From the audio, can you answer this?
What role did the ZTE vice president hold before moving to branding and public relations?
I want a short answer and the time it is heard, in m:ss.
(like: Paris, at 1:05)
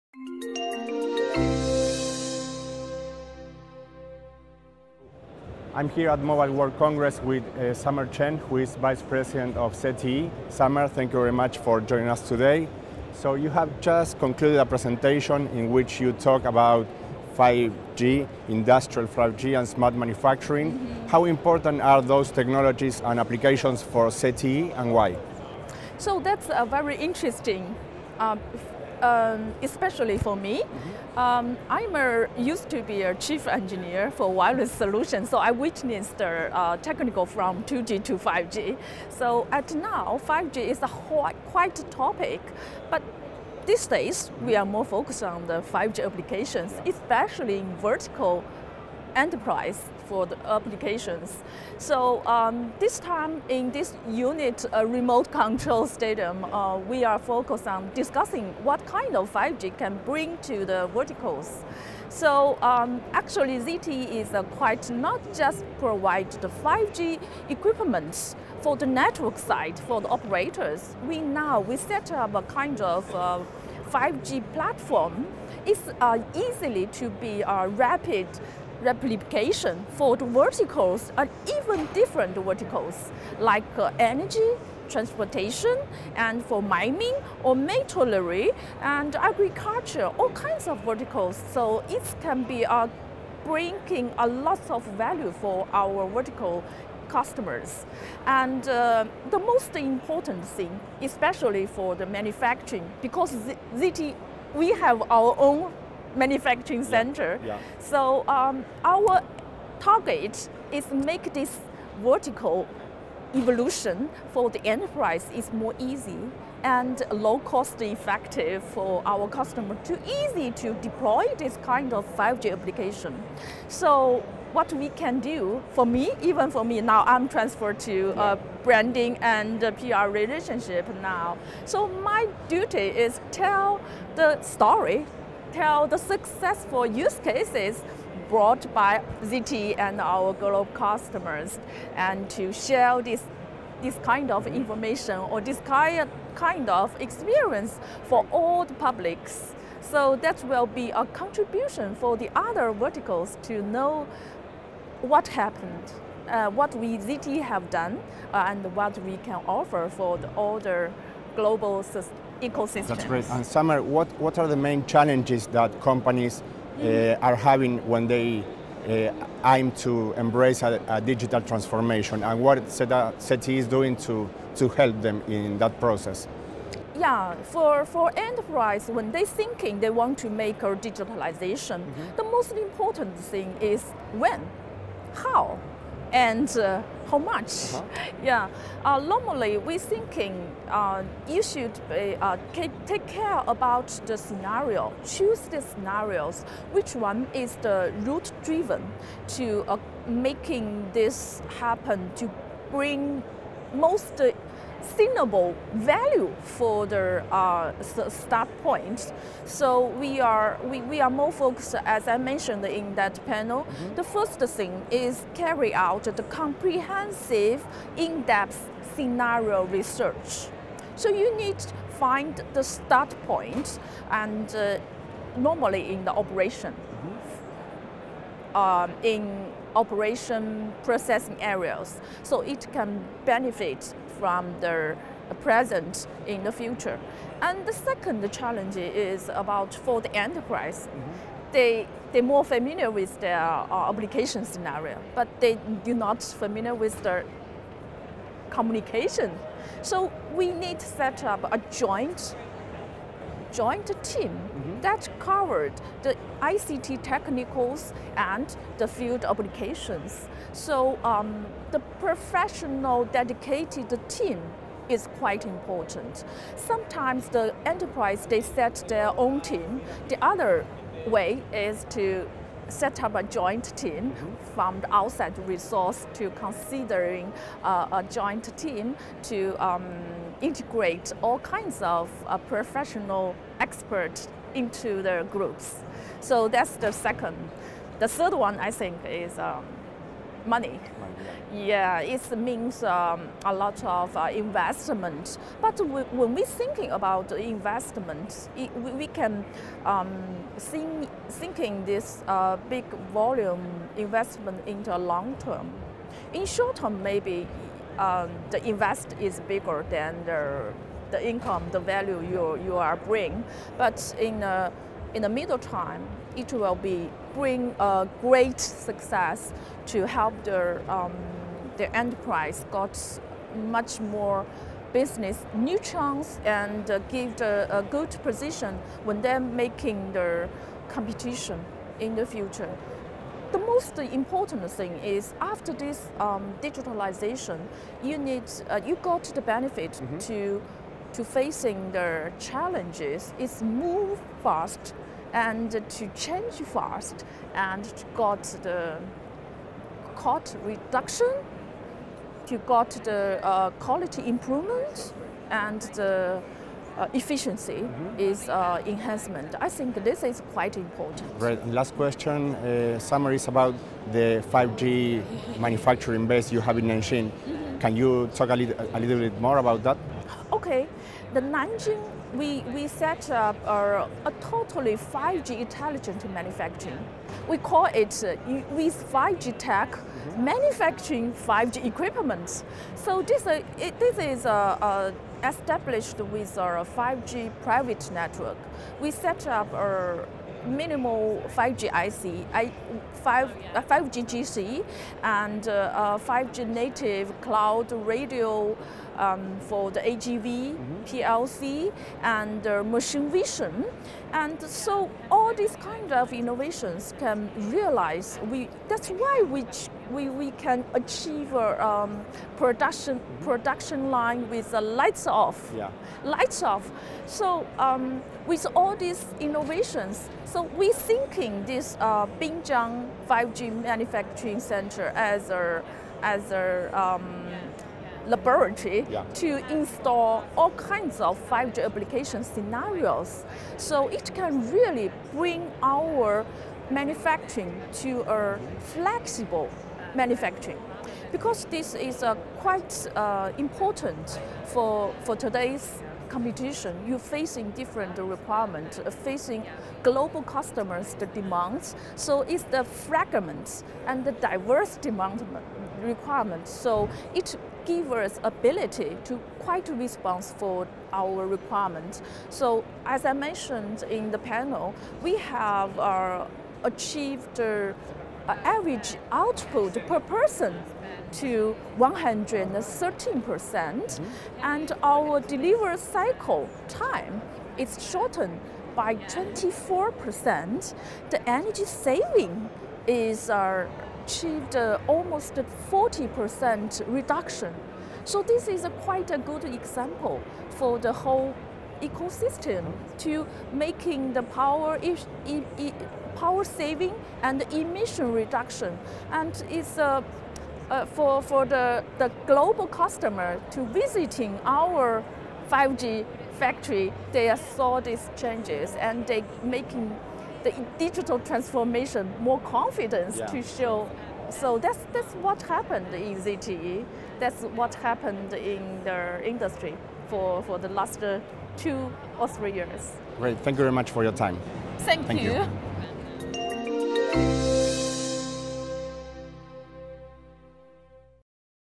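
Chief engineer for wireless solutions, at 0:33.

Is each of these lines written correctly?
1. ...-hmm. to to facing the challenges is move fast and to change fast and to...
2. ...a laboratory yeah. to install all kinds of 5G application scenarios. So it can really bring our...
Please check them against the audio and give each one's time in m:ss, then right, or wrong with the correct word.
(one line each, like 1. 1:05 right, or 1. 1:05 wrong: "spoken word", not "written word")
1. 5:40 right
2. 7:06 right.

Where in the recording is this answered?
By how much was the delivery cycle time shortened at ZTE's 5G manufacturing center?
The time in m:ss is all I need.
7:59.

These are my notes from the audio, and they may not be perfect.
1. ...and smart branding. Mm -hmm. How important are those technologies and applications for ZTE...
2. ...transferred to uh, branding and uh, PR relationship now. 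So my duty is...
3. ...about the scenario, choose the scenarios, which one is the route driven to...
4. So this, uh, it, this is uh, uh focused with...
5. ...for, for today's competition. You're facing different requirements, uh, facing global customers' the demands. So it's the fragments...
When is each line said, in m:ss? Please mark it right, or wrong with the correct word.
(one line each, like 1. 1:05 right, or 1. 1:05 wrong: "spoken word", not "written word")
1. 0:19 wrong: "manufacturing", not "branding"
2. 2:07 right
3. 3:13 right
4. 6:23 wrong: "established", not "focused"
5. 7:24 right.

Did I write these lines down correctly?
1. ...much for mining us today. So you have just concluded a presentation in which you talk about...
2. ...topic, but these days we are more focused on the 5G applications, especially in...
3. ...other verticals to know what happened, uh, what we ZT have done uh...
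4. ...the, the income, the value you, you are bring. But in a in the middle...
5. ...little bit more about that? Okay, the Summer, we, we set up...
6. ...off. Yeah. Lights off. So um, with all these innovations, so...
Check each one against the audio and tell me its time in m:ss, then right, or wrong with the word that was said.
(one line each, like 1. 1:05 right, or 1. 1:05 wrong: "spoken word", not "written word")
1. 0:11 wrong: "joining", not "mining"
2. 0:41 right
3. 2:32 right
4. 5:10 right
5. 6:08 wrong: "Nanjing", not "Summer"
6. 6:55 right.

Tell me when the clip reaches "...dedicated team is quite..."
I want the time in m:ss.
4:23.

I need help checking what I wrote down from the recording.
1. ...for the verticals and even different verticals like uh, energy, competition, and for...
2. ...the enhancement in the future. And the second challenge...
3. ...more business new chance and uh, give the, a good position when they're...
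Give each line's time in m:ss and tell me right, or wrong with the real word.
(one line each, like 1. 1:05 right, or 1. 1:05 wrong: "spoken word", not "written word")
1. 1:19 wrong: "transportation", not "competition"
2. 3:54 wrong: "present", not "enhancement"
3. 5:23 right.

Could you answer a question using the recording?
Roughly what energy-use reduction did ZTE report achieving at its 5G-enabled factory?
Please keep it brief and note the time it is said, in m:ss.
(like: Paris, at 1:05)
Almost 40%, at 8:05.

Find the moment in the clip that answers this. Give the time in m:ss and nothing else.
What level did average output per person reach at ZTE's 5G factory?
7:51.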